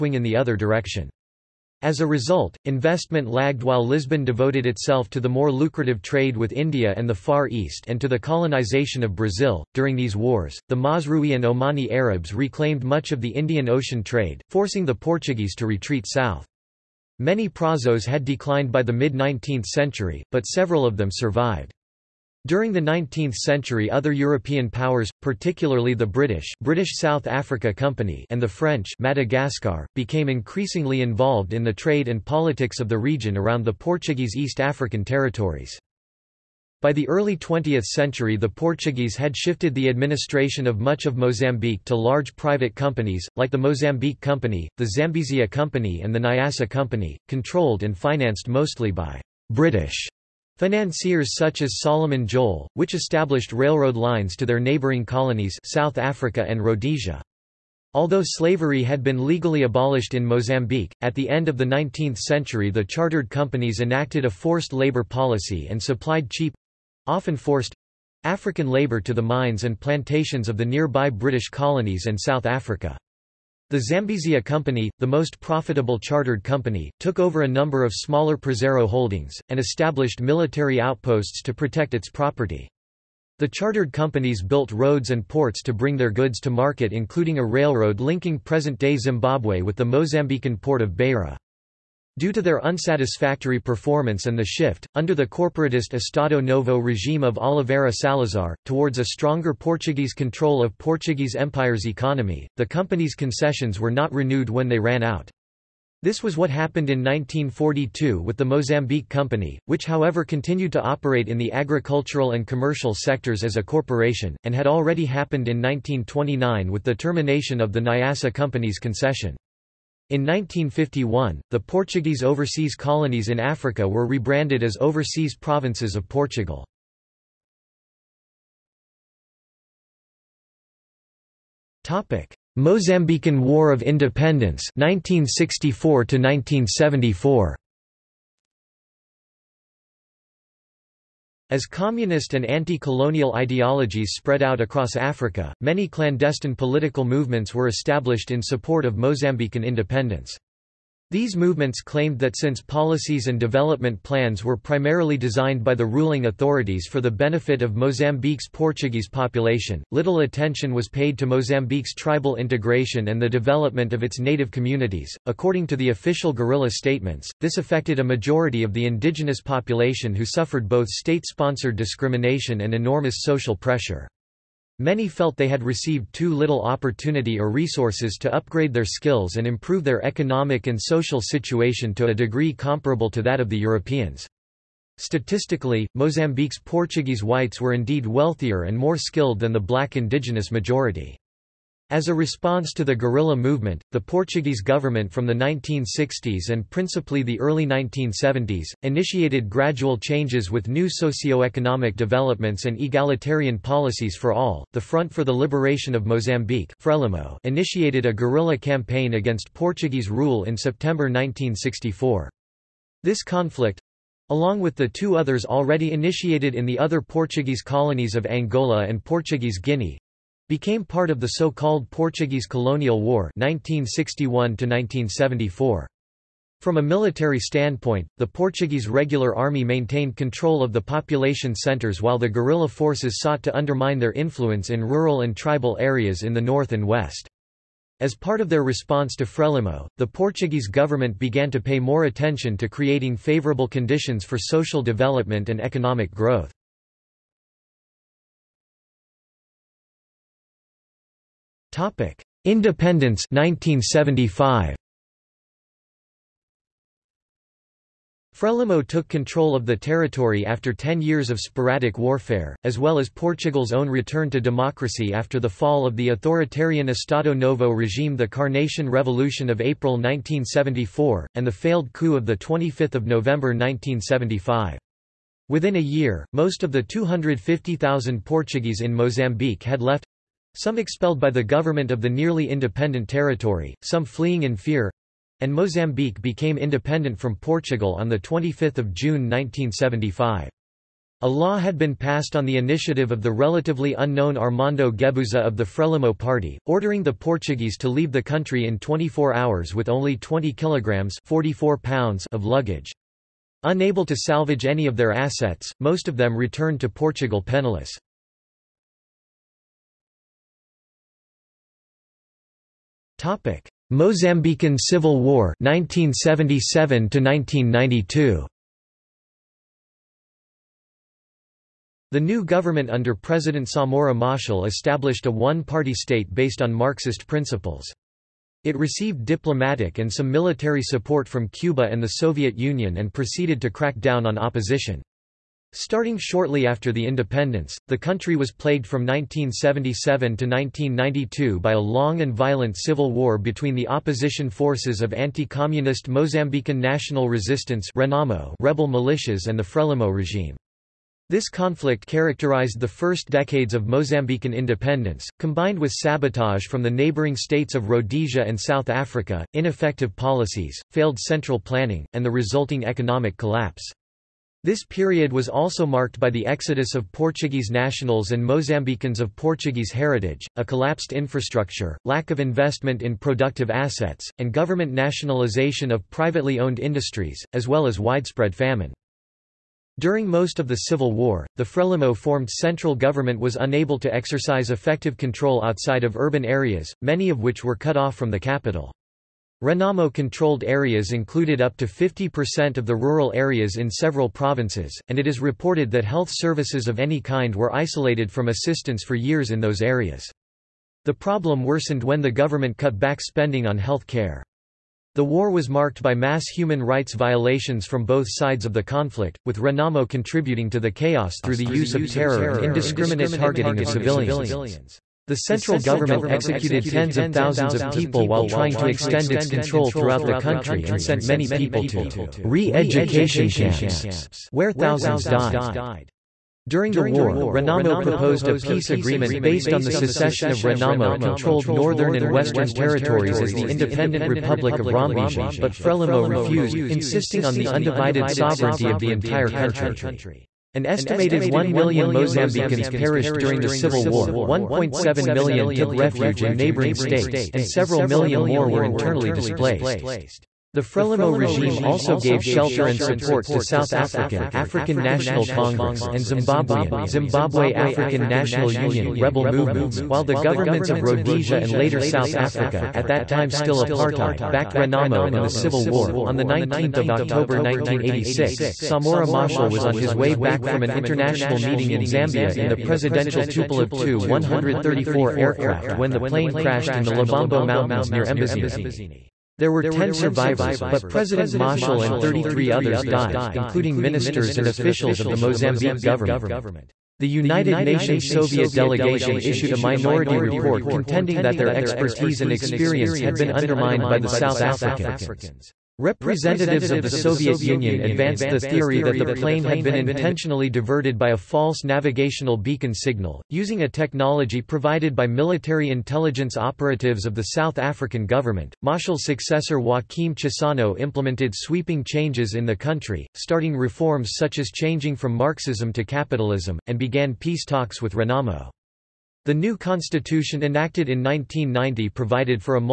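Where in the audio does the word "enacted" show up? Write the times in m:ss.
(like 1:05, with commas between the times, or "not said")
1:03, 8:40.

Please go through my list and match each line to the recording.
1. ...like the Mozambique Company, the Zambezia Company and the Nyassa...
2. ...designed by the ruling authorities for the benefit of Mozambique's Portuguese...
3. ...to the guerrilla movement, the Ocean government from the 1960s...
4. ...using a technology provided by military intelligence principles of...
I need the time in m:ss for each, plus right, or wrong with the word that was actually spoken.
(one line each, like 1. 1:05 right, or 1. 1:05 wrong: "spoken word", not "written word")
1. 0:43 right
2. 2:35 right
3. 3:12 wrong: "Portuguese", not "Ocean"
4. 8:23 wrong: "operatives", not "principles".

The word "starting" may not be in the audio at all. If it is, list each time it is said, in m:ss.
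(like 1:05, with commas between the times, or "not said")
5:35, 8:33.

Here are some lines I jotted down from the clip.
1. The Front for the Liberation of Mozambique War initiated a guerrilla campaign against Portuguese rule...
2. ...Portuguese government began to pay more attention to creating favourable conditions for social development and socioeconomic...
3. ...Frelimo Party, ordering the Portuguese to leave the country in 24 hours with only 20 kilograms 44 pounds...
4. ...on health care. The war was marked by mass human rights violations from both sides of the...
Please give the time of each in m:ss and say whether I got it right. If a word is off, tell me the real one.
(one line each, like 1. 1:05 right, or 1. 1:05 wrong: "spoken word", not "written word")
1. 3:24 wrong: "Frelimo", not "War"
2. 4:00 wrong: "economic", not "socioeconomic"
3. 4:55 right
4. 6:43 right.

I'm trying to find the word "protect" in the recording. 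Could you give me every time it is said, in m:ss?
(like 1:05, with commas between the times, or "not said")
1:21.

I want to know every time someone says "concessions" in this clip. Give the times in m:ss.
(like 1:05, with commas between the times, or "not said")
1:43, 1:58.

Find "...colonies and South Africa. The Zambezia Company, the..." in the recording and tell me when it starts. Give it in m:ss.
1:11.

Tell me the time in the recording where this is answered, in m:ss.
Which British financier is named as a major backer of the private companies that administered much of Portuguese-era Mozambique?
0:51.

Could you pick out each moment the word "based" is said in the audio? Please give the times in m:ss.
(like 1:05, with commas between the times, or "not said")
5:26, 7:09.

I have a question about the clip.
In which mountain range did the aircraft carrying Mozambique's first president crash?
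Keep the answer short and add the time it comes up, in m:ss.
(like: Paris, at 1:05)
Lubombo Mountains, at 7:57.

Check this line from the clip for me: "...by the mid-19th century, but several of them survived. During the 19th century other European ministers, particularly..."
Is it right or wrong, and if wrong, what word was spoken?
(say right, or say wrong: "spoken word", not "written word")
wrong: "powers", not "ministers".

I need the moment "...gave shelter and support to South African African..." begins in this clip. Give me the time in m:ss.
7:32.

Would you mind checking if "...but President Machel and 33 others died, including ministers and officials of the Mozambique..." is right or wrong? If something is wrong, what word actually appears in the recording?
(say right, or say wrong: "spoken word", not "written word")
right.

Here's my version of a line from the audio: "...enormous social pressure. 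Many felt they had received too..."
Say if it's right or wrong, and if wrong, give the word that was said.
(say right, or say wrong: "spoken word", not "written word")
right.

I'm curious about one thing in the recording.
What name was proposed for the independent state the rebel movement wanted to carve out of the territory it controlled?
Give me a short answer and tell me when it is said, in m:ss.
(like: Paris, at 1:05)
Republic of Rombezia, at 7:14.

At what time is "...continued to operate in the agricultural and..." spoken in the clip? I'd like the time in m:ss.
1:50.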